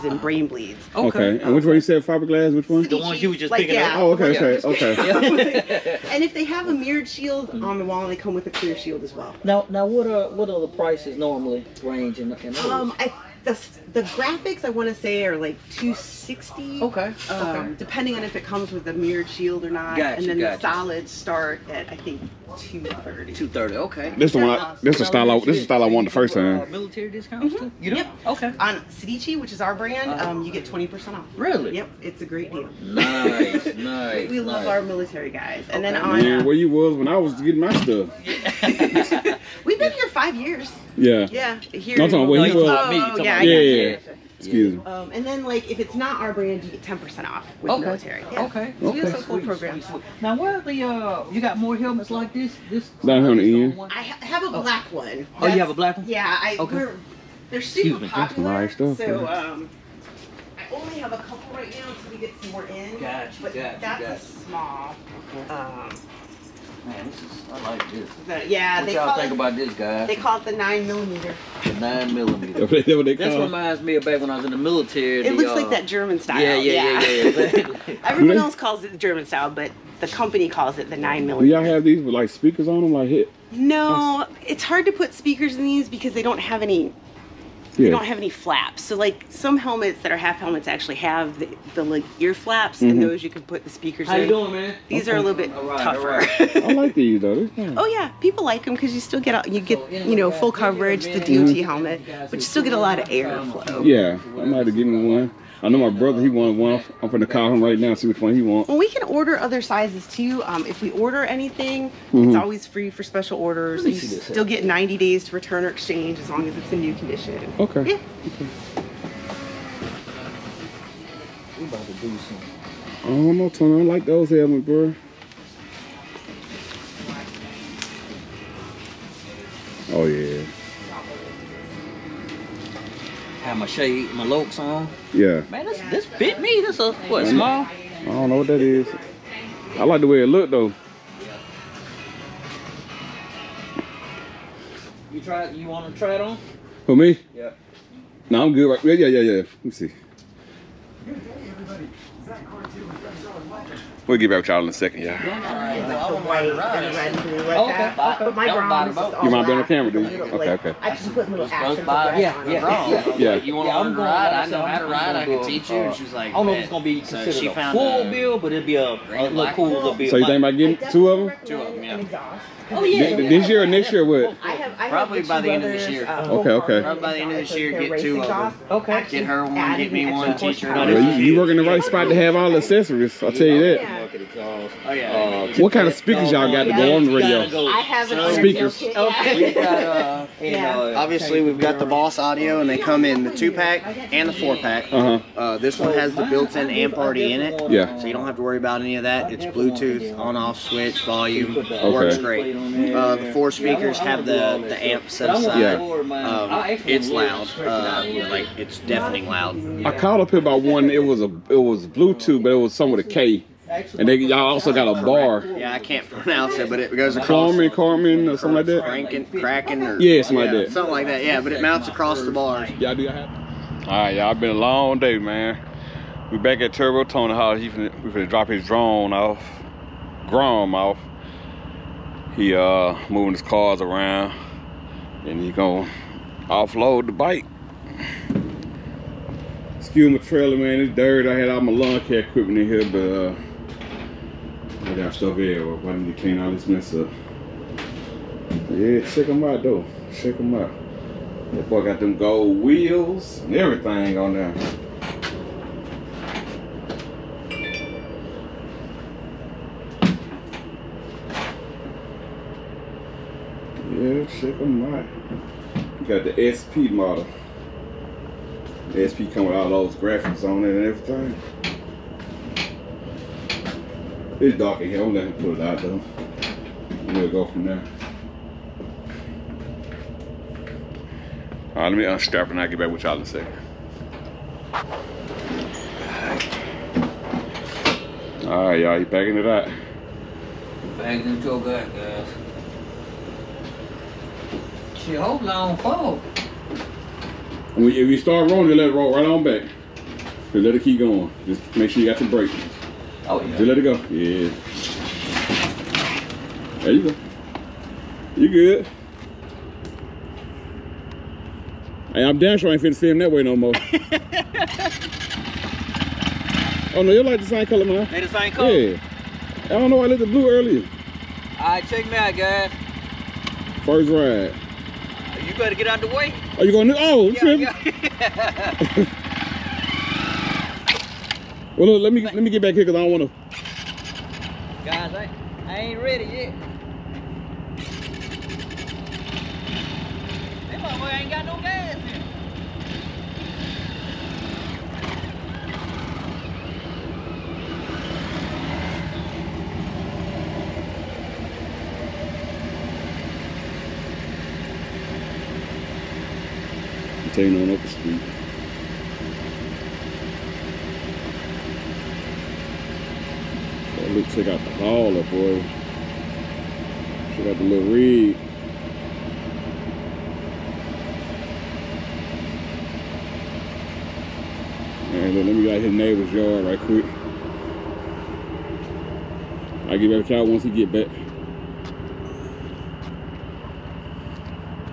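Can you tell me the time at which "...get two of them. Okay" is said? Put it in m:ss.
2:57.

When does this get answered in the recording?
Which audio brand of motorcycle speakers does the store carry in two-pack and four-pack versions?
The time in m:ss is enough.
3:11.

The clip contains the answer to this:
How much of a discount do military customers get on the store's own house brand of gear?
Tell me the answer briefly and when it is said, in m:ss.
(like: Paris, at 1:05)
20%, at 0:30.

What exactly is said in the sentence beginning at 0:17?
Depending on if it comes with a mirrored shield or not.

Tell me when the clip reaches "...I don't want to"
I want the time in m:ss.
5:32.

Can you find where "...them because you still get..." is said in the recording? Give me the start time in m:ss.
1:38.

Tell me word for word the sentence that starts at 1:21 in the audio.
Do y'all have these with like speakers on them, like hit?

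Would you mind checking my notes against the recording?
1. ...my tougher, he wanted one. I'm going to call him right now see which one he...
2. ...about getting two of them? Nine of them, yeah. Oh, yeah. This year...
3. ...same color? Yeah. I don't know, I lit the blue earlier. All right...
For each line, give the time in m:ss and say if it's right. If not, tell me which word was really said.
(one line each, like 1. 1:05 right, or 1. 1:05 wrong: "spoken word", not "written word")
1. 1:45 wrong: "brother", not "tougher"
2. 2:50 wrong: "Two", not "Nine"
3. 5:18 right.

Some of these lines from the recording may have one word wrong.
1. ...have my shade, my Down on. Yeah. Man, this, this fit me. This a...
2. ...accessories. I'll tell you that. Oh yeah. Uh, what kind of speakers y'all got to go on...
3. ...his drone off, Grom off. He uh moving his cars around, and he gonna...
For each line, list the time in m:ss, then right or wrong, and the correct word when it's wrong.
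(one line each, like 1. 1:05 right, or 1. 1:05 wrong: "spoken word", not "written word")
1. 2:13 wrong: "Locs", not "Down"
2. 3:02 right
3. 3:48 right.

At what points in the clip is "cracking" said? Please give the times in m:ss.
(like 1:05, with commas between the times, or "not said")
3:39.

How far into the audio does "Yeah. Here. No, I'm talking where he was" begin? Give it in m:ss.
0:41.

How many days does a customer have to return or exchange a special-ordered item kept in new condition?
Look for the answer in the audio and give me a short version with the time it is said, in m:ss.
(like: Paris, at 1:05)
90, at 1:54.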